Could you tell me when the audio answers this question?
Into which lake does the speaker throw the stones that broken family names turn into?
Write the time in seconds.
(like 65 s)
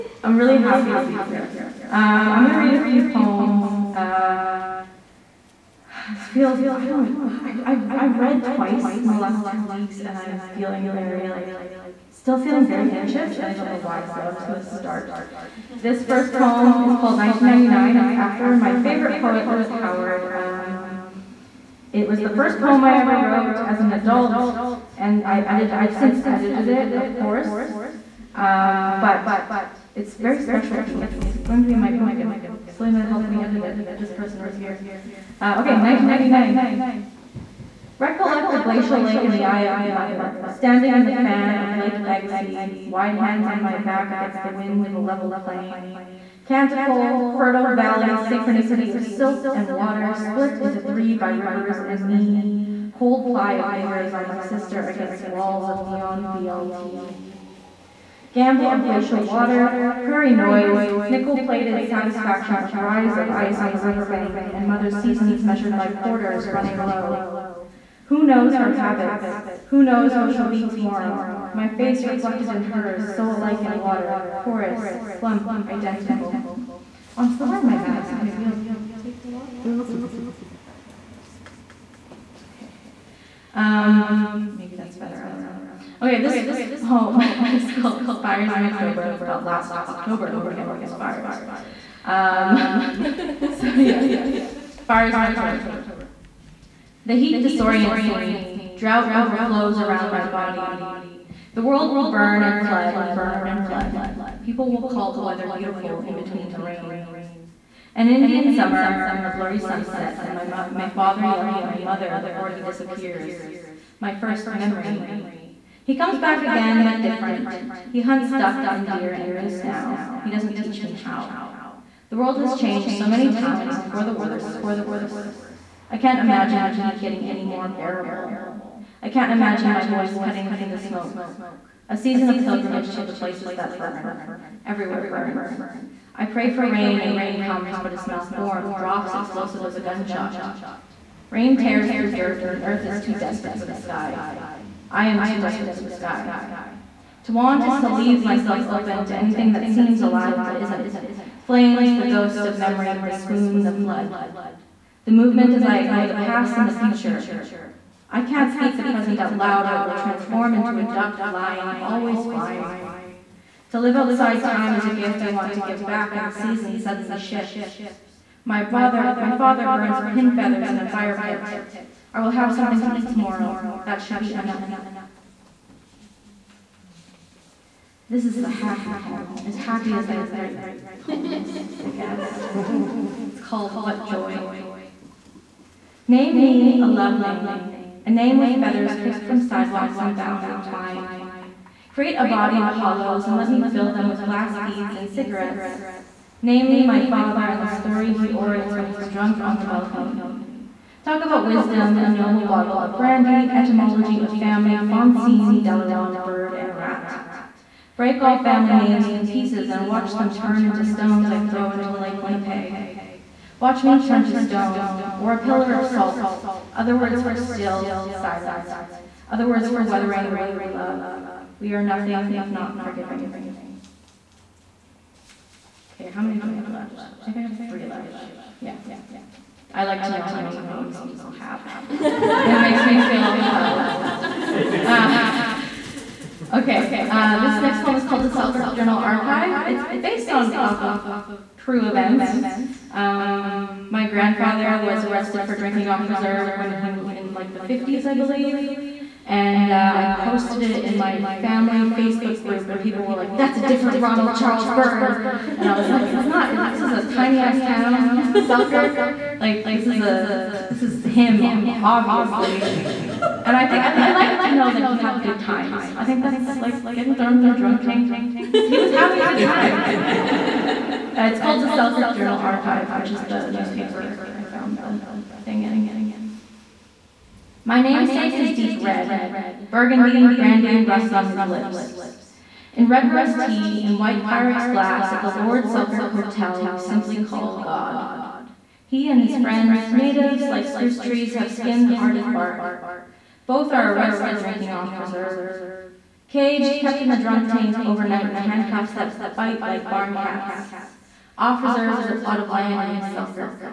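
211 s.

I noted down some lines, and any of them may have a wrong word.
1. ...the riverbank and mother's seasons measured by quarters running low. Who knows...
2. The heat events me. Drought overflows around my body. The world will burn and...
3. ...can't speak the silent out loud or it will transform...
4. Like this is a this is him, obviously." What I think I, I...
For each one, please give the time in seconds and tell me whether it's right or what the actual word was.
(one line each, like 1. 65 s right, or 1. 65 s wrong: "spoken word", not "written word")
1. 63 s right
2. 97 s wrong: "disorients", not "events"
3. 158 s wrong: "present", not "silent"
4. 259 s wrong: "And", not "What".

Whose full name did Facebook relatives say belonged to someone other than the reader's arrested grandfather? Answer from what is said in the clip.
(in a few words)
Ronald Charles Byrd.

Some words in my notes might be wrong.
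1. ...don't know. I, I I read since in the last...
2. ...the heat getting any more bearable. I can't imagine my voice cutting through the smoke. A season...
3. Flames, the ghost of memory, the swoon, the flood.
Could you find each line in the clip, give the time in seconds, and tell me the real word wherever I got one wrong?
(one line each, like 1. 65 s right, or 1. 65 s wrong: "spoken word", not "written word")
1. 6 s wrong: "twice", not "since"
2. 126 s right
3. 151 s right.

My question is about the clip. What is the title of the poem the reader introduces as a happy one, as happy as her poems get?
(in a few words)
What Joy.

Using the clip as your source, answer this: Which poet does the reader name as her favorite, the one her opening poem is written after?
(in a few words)
Liz Howard.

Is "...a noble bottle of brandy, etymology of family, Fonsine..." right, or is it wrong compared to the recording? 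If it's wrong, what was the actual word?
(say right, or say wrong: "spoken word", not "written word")
right.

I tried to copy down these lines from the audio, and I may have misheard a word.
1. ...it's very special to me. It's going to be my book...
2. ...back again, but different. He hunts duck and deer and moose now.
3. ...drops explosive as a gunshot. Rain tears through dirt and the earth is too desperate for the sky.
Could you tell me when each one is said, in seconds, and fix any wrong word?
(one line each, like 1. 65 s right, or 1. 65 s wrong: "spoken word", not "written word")
1. 29 s right
2. 116 s right
3. 138 s right.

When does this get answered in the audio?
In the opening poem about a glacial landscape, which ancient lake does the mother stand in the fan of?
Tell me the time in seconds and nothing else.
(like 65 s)
41 s.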